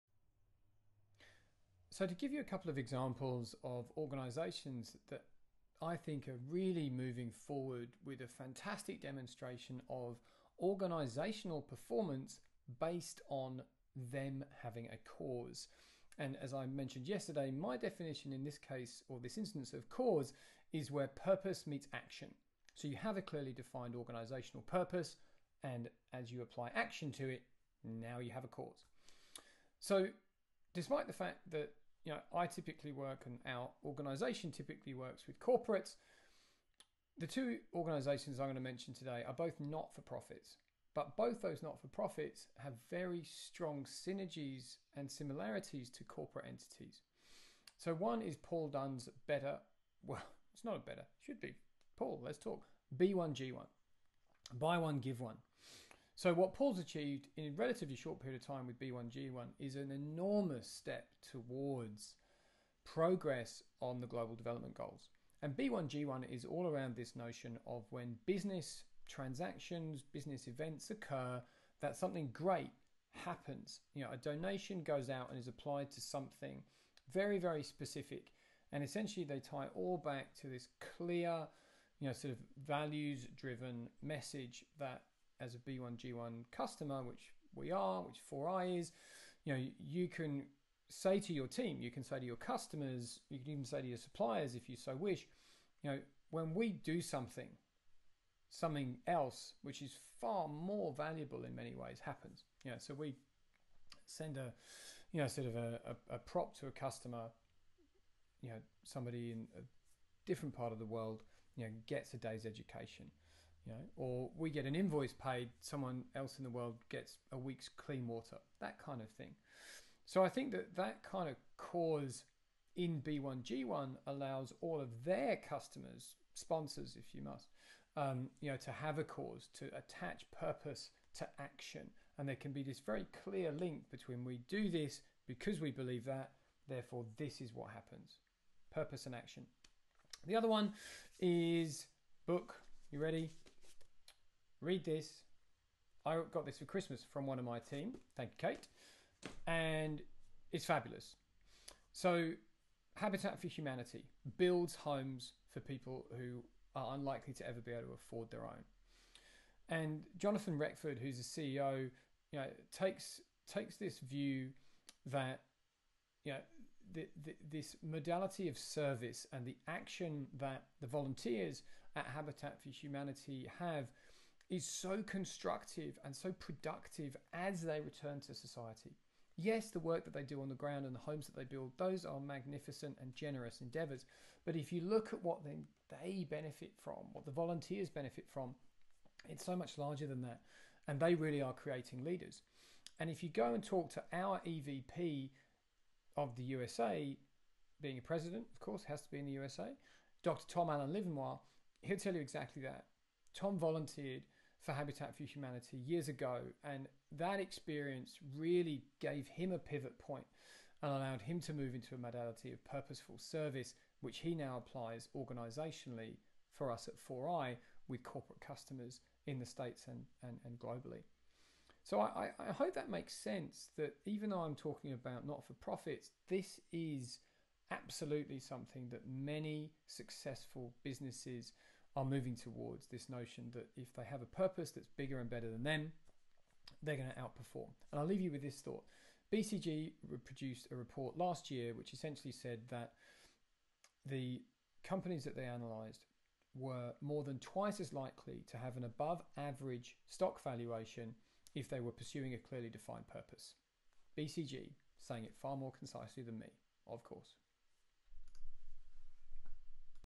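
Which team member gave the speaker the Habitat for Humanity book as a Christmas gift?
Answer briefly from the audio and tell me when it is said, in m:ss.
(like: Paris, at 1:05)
Kate, at 2:28.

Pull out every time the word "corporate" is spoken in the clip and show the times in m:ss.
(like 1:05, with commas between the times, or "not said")
0:35, 0:46, 3:38.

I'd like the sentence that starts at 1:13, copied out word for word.
You know, a donation goes out and is applied to something very, very specific.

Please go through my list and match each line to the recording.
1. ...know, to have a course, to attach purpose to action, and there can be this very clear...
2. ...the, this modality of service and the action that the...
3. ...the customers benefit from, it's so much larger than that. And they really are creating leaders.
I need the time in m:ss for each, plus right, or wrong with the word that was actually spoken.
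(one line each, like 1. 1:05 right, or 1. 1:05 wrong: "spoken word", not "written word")
1. 2:08 wrong: "cause", not "course"
2. 2:47 right
3. 3:07 wrong: "volunteers", not "customers".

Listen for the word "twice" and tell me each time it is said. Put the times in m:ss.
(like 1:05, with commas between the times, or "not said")
4:07.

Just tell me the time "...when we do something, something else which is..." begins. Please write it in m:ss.
1:36.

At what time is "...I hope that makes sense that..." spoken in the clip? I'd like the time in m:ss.
3:42.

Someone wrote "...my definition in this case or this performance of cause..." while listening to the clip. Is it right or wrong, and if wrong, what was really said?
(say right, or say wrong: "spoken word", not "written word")
wrong: "instance", not "performance".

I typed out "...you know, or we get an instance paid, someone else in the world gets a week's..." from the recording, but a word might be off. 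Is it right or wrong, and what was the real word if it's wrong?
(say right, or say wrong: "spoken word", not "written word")
wrong: "invoice", not "instance".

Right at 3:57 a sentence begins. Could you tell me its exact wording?
And I'll leave you with this thought.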